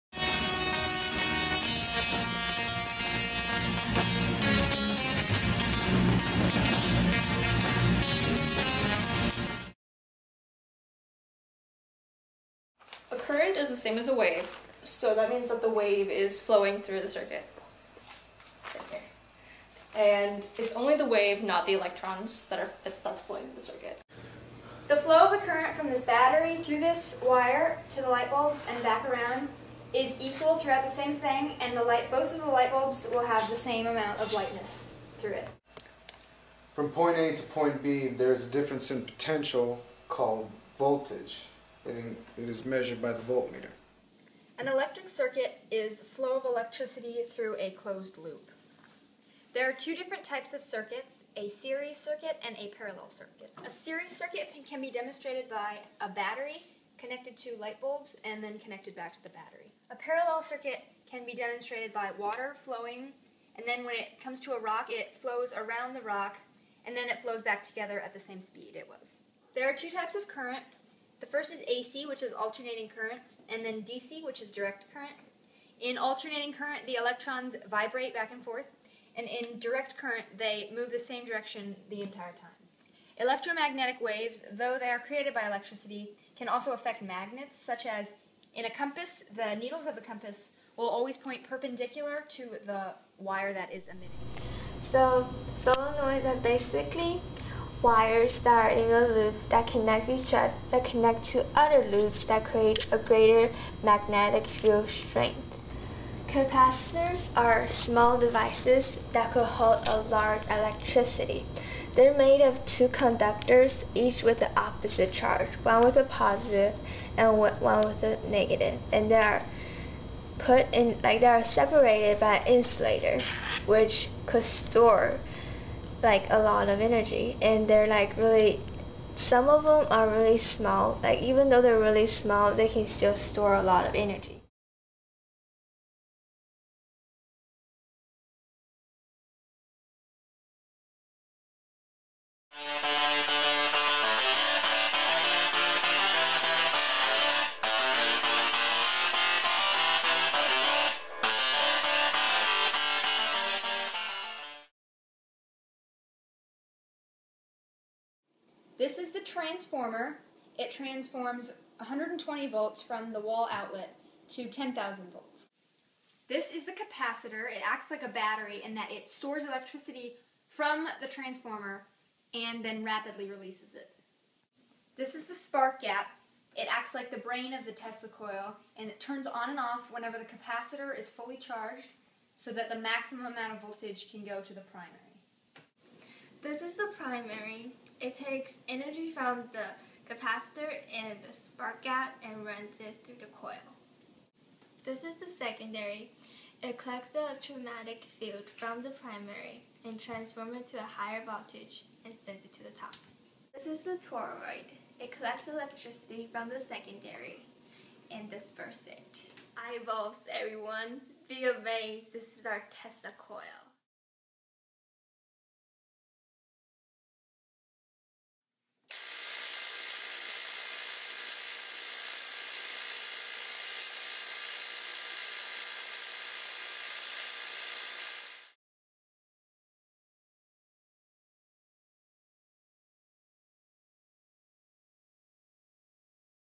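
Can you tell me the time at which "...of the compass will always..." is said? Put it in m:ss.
1:29.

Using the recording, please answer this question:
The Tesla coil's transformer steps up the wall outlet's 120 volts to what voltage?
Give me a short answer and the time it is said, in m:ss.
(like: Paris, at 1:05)
10,000 volts, at 2:44.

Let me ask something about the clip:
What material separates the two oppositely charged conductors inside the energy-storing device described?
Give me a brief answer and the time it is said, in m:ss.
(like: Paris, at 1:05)
an insulator, at 2:02.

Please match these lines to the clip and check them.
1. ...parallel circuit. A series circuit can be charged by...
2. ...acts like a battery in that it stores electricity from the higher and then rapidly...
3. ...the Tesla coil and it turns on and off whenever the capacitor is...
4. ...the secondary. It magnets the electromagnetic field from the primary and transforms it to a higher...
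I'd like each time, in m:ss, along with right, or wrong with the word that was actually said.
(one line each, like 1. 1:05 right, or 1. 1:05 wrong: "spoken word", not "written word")
1. 0:52 wrong: "demonstrated", not "charged"
2. 2:47 wrong: "transformer", not "higher"
3. 2:57 right
4. 3:15 wrong: "collects", not "magnets".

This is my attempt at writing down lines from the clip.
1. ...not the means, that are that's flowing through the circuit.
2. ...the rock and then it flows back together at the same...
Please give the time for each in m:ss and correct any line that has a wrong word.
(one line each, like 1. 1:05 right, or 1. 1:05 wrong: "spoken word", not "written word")
1. 0:21 wrong: "electrons", not "means"
2. 1:05 right.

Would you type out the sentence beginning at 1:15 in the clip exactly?
In alternating current, the electrons vibrate back and forth, and in direct current, they move the same direction the entire time.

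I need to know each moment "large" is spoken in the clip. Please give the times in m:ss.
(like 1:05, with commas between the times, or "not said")
1:50.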